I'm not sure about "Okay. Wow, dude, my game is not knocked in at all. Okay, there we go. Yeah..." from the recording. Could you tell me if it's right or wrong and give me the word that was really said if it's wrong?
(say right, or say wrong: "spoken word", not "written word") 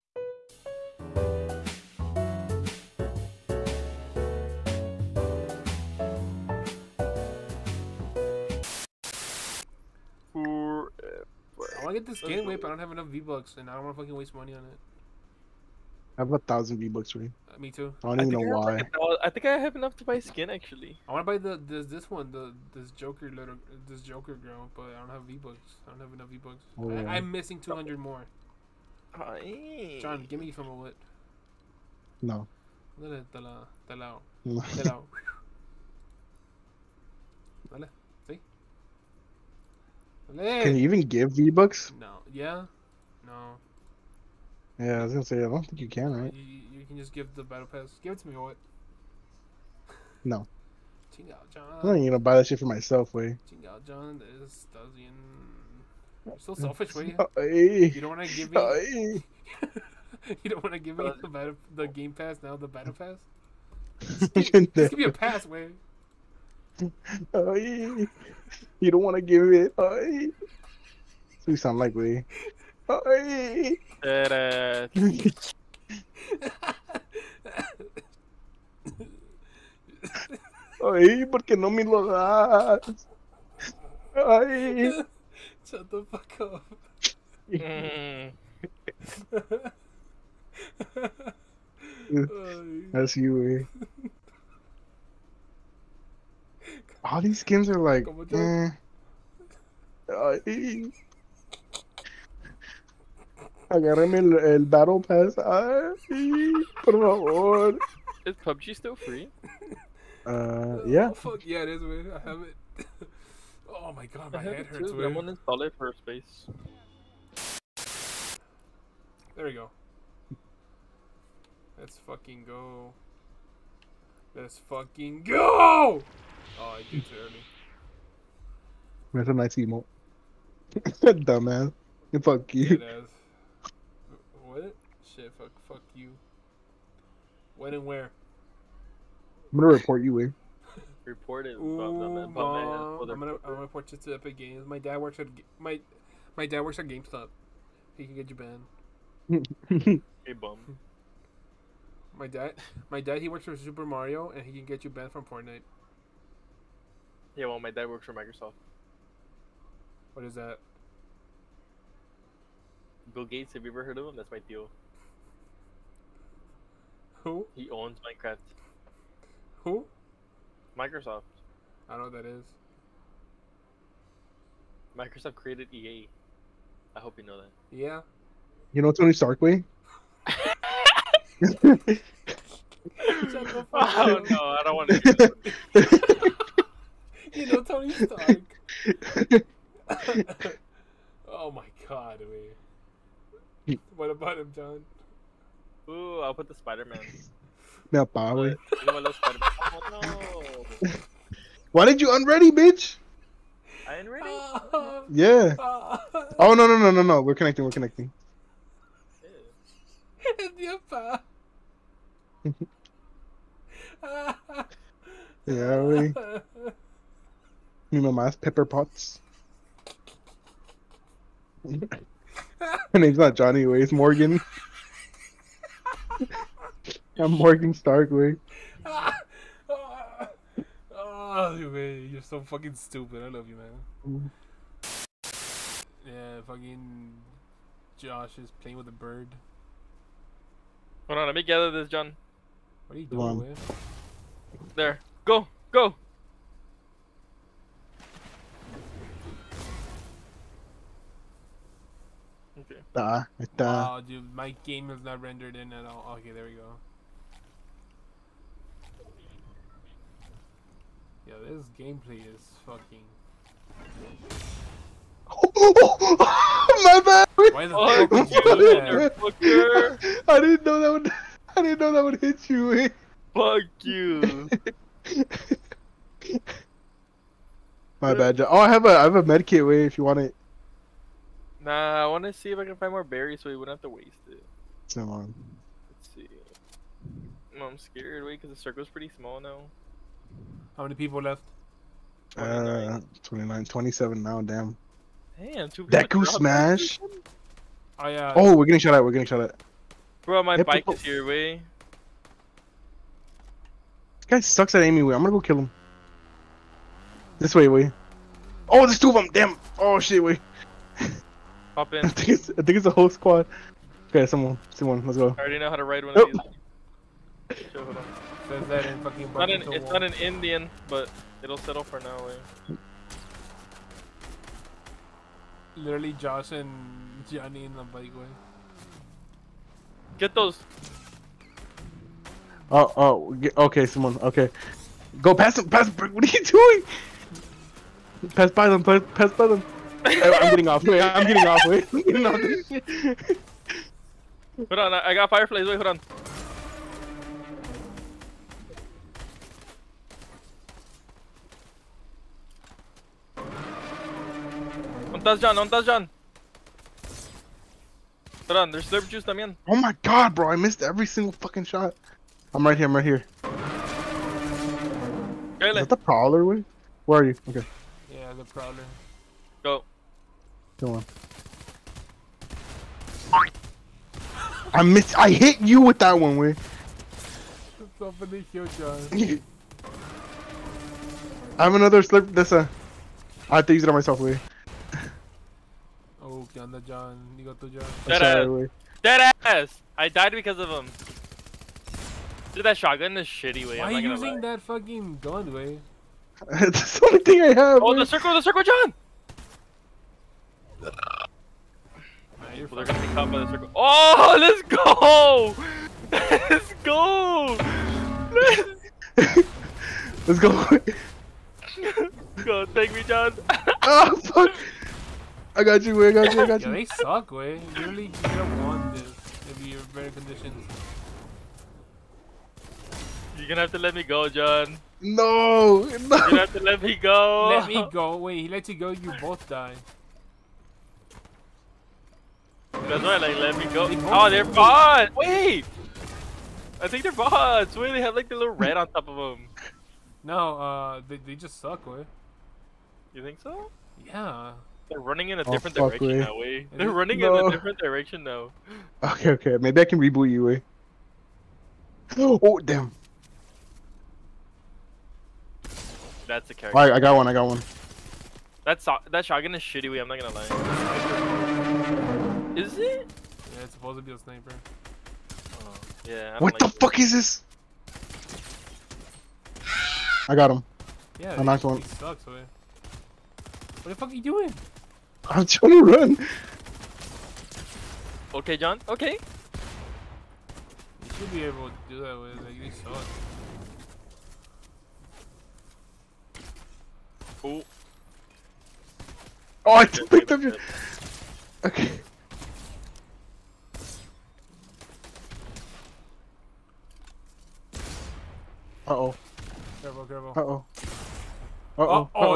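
wrong: "rendered", not "knocked".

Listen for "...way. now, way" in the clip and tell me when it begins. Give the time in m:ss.
7:26.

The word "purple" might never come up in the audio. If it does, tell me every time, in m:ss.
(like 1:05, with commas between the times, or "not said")
not said.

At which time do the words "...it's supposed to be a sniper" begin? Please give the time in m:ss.
7:43.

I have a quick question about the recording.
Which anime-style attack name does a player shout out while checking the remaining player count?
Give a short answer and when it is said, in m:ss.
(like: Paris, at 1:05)
Deku smash, at 4:55.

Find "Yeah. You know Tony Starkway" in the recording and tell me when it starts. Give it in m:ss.
2:57.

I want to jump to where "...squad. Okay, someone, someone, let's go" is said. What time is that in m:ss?
5:13.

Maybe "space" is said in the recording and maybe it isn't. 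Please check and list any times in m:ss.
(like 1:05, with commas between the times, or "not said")
1:55.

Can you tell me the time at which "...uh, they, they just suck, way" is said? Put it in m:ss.
7:20.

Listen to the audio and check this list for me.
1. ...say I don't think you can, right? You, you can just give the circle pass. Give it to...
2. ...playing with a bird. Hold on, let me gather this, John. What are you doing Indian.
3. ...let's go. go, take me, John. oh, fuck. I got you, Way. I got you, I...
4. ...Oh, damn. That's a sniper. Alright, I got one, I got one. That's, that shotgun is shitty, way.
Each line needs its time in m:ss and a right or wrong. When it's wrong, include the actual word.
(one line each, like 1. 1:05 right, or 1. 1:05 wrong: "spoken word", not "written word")
1. 0:45 wrong: "battle", not "circle"
2. 3:58 wrong: "There", not "Indian"
3. 6:50 right
4. 7:32 wrong: "character", not "sniper".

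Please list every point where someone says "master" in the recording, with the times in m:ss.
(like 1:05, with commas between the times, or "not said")
not said.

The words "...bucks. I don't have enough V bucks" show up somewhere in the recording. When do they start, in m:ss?
0:25.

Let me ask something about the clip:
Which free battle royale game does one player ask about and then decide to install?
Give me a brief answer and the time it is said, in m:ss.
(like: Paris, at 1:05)
PUBG, at 1:48.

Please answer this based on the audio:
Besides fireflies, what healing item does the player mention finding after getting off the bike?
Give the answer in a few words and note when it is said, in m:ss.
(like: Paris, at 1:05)
slurp juice, at 5:58.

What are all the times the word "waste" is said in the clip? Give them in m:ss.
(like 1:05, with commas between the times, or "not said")
0:14, 4:43.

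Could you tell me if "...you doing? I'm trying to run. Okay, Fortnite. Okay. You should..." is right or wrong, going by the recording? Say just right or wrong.
wrong.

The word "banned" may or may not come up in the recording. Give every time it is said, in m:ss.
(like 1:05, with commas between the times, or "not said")
2:28, 2:34.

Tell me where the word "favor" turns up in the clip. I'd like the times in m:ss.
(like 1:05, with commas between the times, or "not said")
1:46.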